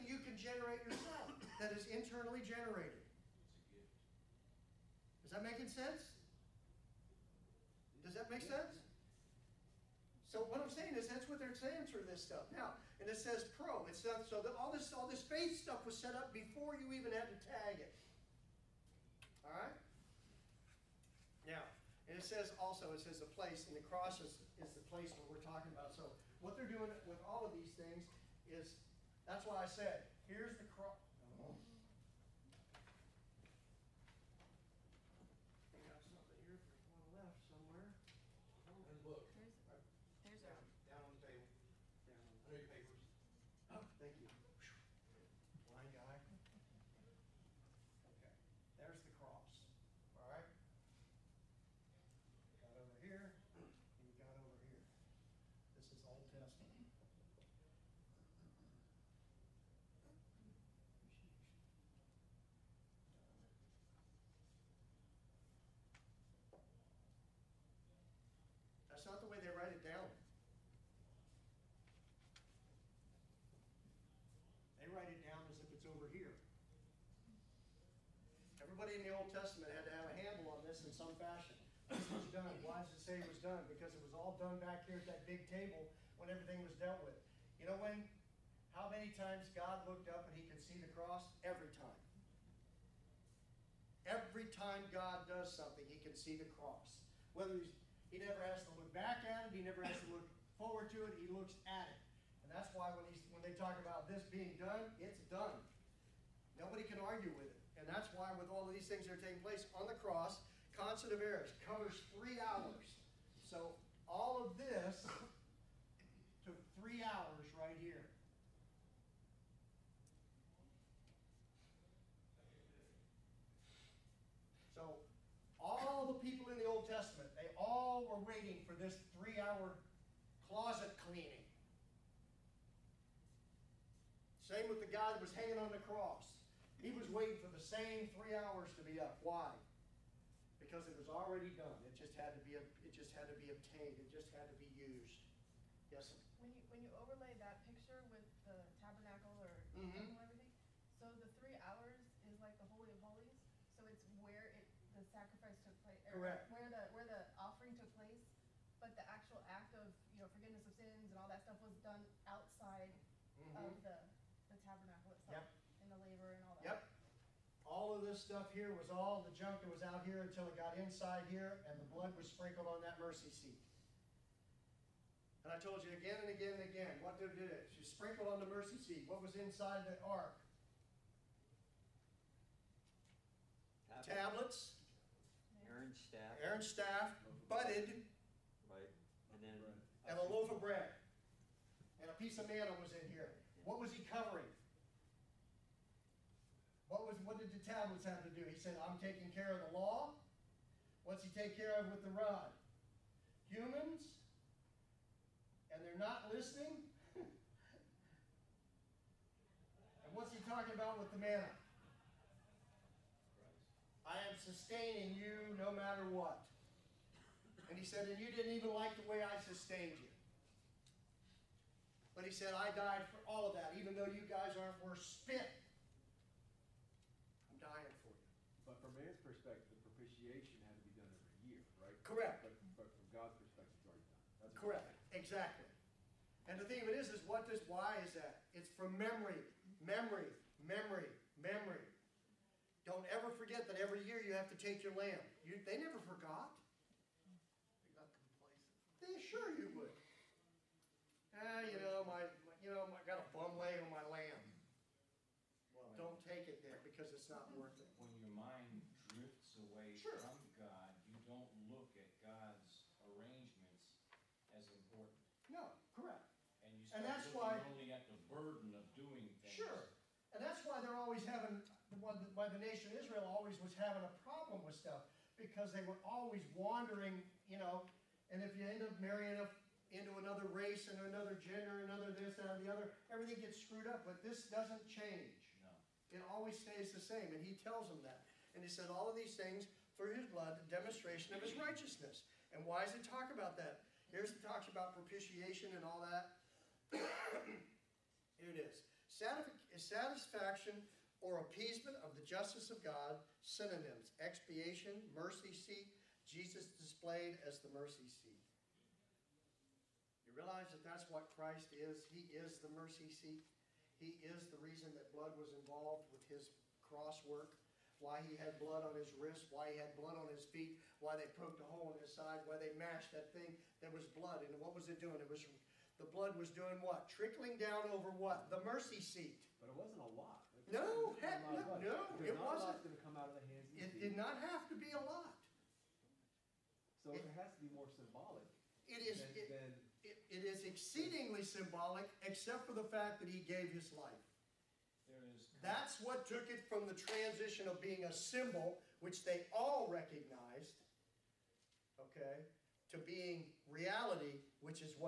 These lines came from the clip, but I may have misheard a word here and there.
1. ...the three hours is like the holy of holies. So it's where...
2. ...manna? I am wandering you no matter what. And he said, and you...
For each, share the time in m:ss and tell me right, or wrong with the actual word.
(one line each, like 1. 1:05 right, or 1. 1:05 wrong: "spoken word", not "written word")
1. 2:31 right
2. 3:31 wrong: "sustaining", not "wandering".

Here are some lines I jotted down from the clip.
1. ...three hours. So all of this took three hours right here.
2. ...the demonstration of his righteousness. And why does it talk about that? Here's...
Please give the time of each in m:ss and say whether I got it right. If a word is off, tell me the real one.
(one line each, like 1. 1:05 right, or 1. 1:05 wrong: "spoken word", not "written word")
1. 1:52 right
2. 4:50 right.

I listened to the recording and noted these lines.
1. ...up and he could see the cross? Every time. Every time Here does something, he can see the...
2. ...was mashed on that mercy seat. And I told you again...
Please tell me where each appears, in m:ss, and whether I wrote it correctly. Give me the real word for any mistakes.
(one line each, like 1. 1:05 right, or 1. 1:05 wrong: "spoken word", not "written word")
1. 1:30 wrong: "God", not "Here"
2. 2:52 wrong: "sprinkled", not "mashed".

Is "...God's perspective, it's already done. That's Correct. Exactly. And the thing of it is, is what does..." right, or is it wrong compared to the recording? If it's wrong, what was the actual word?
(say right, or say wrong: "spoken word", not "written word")
right.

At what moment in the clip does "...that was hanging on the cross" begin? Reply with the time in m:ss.
2:15.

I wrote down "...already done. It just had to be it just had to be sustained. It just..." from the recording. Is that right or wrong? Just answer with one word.
wrong.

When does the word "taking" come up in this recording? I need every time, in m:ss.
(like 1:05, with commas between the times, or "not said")
1:49, 3:18.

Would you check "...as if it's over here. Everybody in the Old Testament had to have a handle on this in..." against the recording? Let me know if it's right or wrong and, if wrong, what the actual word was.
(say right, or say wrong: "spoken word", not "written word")
right.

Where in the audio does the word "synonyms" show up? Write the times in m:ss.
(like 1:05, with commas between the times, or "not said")
5:03.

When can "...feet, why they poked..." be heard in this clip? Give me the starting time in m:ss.
5:20.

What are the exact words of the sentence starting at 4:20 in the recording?
from God, you don't look at God's arrangements as important.